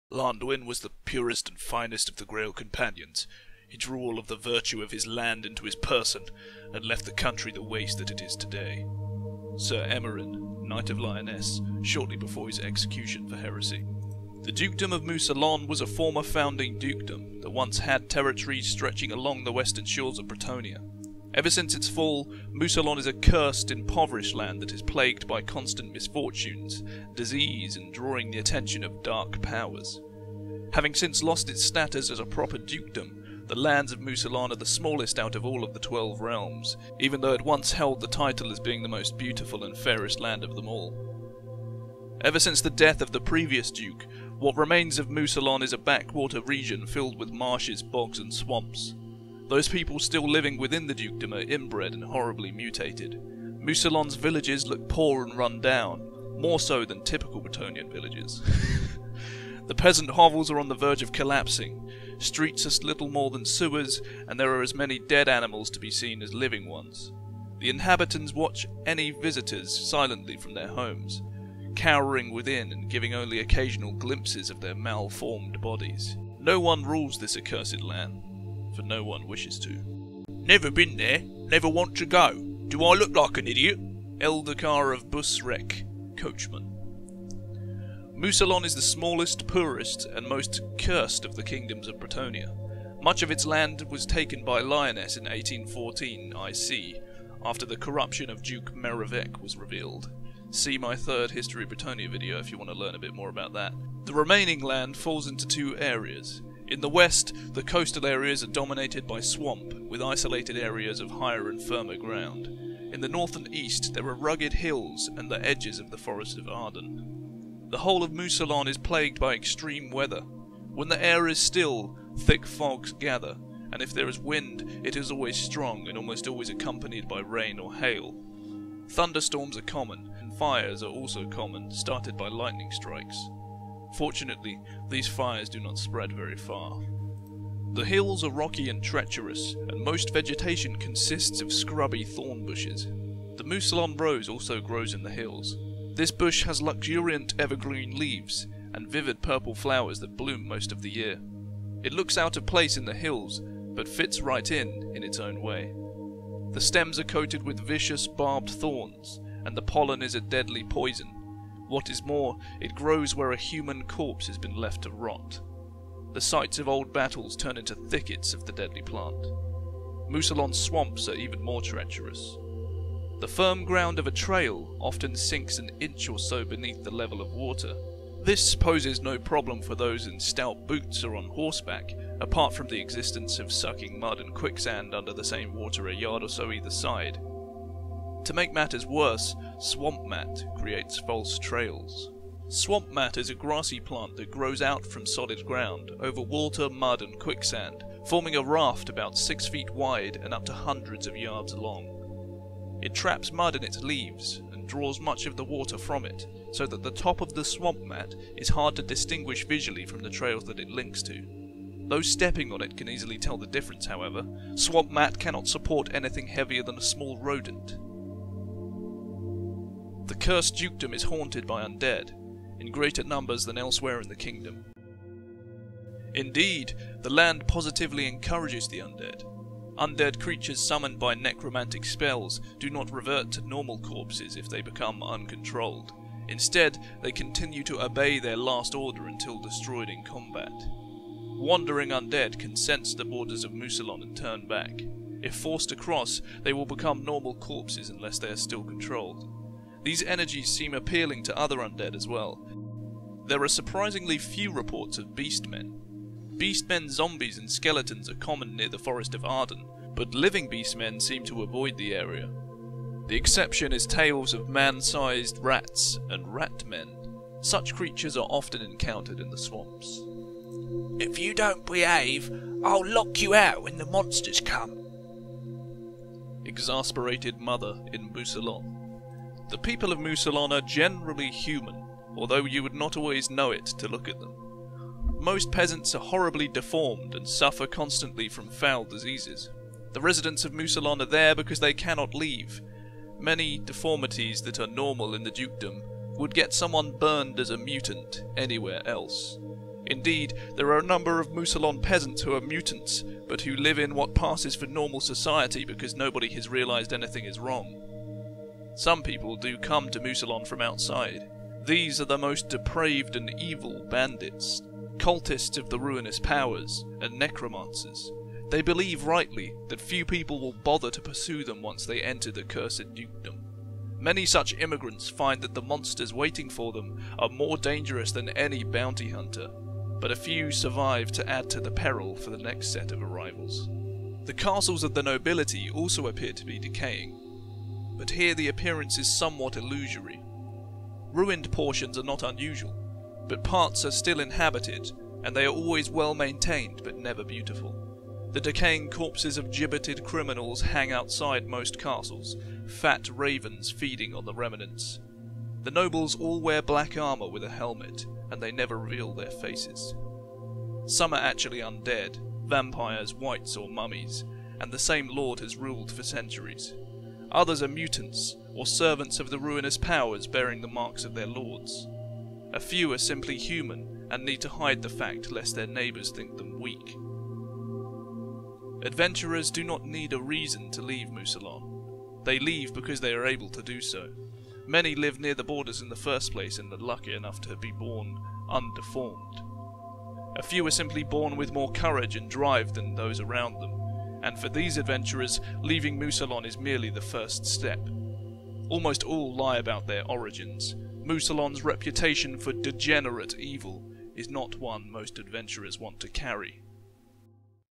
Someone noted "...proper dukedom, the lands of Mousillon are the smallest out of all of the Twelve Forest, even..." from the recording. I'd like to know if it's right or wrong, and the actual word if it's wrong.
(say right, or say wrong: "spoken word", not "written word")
wrong: "Realms", not "Forest".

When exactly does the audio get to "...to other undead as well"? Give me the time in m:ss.
4:11.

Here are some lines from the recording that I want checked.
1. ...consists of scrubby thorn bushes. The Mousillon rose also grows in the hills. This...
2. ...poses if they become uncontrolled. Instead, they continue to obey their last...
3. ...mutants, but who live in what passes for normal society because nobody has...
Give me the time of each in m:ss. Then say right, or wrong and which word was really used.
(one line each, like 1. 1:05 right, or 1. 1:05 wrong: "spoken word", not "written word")
1. 2:20 right
2. 3:53 wrong: "corpses", not "poses"
3. 5:02 right.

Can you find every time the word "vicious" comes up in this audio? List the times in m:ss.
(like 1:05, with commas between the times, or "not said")
2:37.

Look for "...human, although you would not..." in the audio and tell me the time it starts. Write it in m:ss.
4:41.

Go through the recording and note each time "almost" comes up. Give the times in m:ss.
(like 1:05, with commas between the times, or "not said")
2:05, 6:38.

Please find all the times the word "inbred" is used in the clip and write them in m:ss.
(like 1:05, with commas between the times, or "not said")
0:51.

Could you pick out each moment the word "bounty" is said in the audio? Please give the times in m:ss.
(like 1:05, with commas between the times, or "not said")
5:28.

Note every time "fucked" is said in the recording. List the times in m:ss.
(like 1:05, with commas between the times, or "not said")
not said.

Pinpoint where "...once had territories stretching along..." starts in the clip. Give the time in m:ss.
0:17.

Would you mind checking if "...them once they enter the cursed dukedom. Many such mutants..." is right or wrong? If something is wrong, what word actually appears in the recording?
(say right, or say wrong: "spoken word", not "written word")
wrong: "immigrants", not "mutants".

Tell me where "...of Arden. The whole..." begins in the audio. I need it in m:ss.
1:56.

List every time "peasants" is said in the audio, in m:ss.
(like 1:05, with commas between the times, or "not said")
0:59, 4:45, 5:01.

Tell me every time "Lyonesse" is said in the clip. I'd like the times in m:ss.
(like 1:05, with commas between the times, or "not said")
0:10, 1:34.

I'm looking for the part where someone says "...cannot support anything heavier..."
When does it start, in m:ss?
3:35.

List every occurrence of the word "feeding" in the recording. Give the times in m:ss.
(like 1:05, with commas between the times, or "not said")
5:53.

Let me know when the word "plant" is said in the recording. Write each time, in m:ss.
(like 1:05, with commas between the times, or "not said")
2:48, 3:13.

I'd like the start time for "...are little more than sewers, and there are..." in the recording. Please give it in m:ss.
1:02.